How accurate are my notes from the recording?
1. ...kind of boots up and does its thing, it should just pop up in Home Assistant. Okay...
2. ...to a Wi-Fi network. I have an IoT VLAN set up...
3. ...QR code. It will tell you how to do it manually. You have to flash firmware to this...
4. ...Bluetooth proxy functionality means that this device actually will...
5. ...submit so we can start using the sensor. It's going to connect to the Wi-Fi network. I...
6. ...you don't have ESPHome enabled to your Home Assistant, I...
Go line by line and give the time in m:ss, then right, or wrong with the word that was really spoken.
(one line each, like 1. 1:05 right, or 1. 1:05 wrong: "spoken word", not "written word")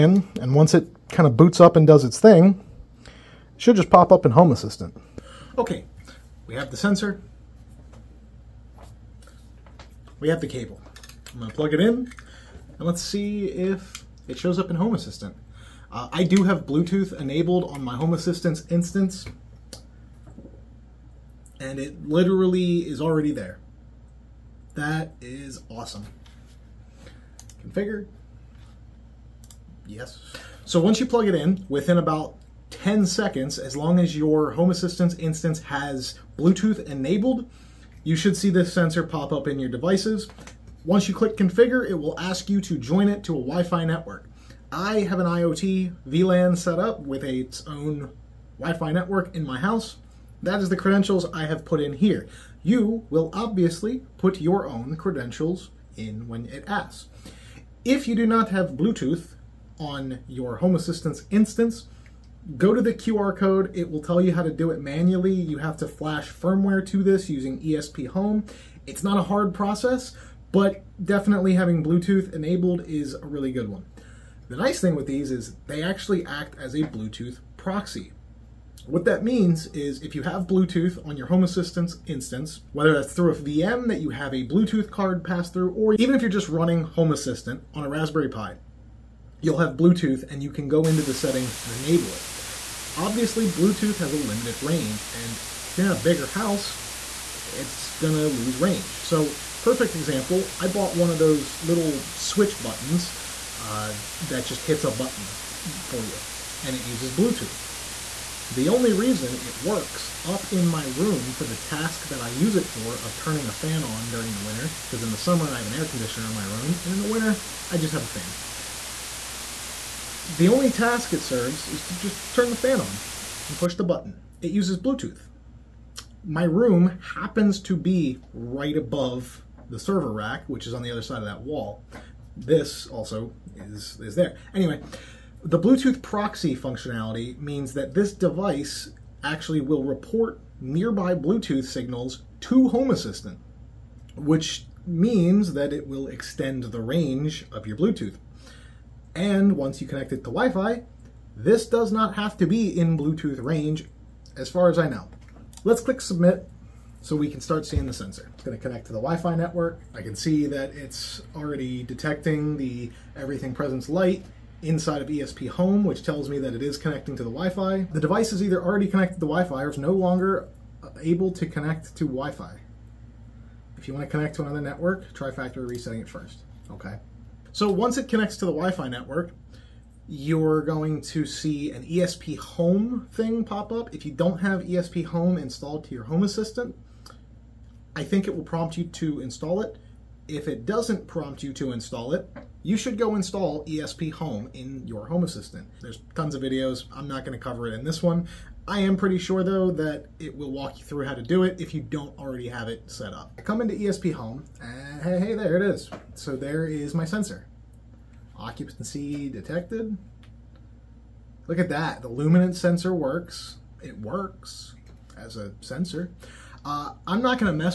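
1. 0:01 right
2. 0:43 right
3. 1:02 right
4. 2:15 right
5. 2:36 wrong: "seeing", not "using"
6. 3:04 wrong: "installed", not "enabled".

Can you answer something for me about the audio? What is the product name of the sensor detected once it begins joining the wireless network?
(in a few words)
Everything Presence Lite.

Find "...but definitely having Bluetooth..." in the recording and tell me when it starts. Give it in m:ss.
1:10.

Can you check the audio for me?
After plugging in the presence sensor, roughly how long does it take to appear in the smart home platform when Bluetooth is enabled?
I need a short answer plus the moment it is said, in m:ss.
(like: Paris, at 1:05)
10 seconds, at 0:32.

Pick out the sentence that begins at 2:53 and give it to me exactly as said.
If you want to connect to another network, try factory resetting it first, okay?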